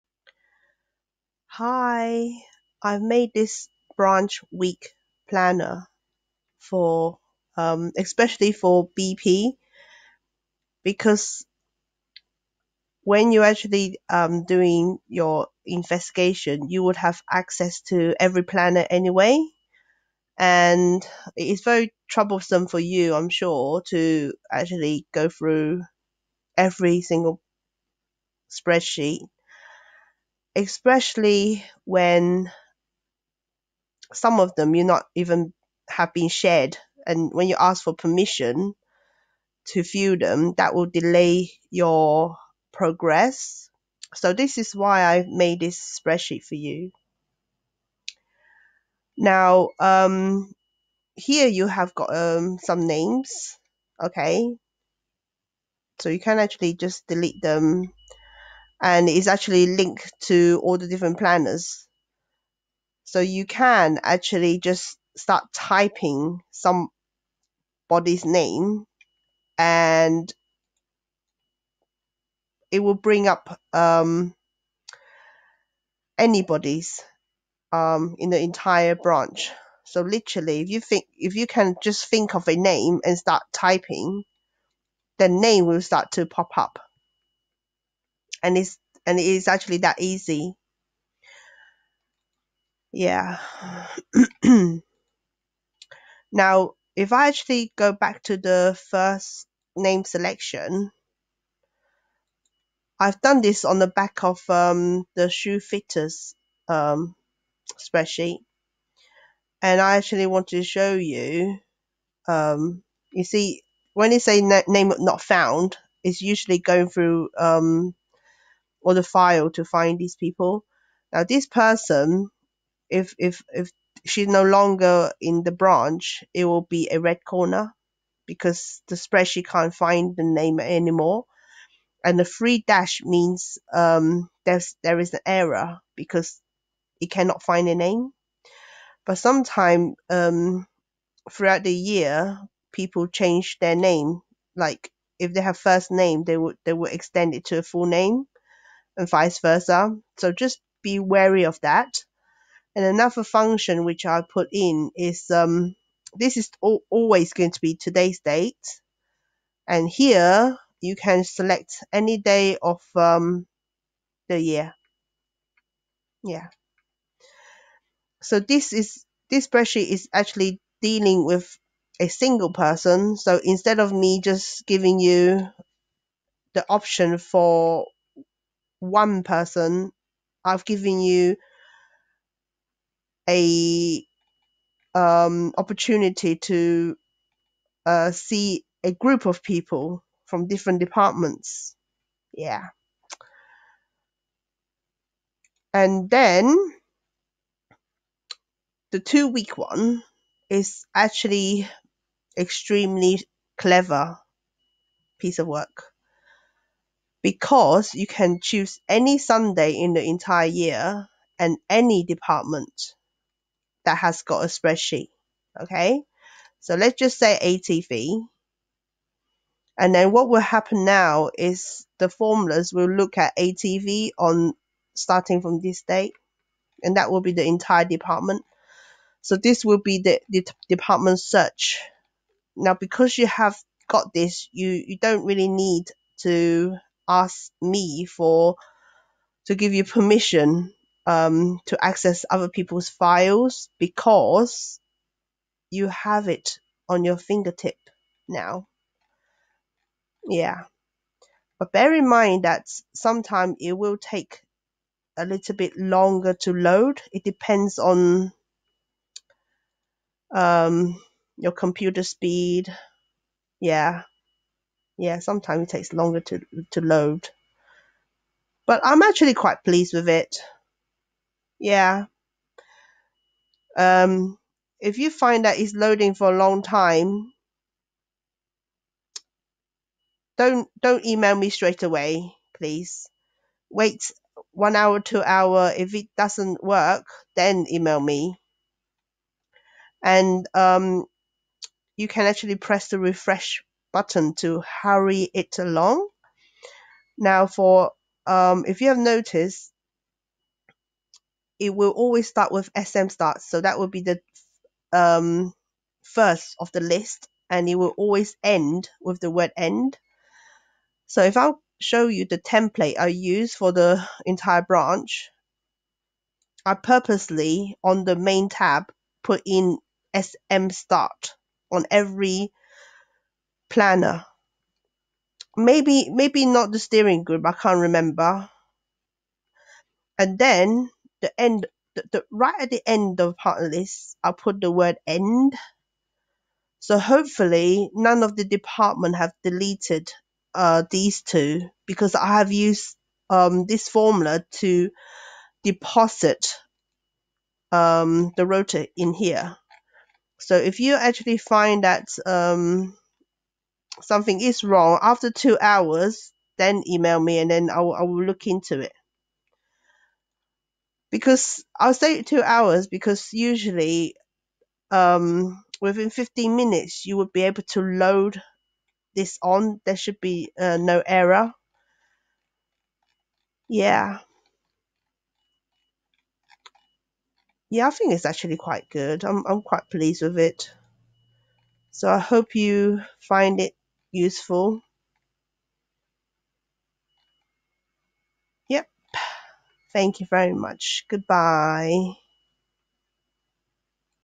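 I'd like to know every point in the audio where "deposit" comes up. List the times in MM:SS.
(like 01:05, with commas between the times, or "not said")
05:45.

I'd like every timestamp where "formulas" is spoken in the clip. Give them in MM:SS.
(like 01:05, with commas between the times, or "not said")
03:42, 05:43.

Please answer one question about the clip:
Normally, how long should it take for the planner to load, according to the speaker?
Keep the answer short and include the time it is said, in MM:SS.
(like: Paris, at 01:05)
15 minutes, at 06:06.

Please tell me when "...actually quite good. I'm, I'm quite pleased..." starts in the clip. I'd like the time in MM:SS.
06:18.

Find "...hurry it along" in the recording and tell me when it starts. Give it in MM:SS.
04:54.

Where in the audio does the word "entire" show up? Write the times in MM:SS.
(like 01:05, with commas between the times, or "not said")
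01:18, 03:30, 03:47, 05:14.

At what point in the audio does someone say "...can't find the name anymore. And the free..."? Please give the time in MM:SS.
02:09.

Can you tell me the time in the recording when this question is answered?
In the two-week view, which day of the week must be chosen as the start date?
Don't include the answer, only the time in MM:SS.
03:29.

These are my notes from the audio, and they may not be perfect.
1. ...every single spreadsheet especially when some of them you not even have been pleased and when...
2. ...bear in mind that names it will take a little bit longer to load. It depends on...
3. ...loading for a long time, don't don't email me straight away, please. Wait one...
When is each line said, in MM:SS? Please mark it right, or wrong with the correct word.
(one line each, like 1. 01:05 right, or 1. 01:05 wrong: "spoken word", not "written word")
1. 00:26 wrong: "shared", not "pleased"
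2. 04:11 wrong: "sometimes", not "names"
3. 04:35 right.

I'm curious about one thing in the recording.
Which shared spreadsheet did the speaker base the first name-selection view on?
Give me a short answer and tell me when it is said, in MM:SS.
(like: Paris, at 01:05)
shoe fitters, at 01:45.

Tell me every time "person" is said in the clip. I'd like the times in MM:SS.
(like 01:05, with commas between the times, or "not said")
02:01, 02:52, 02:59.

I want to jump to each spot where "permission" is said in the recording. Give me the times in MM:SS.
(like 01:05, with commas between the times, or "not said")
00:37, 03:59.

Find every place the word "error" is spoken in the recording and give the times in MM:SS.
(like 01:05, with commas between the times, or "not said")
02:15, 06:11.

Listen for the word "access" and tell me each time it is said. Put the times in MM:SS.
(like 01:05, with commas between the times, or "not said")
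00:17, 04:01.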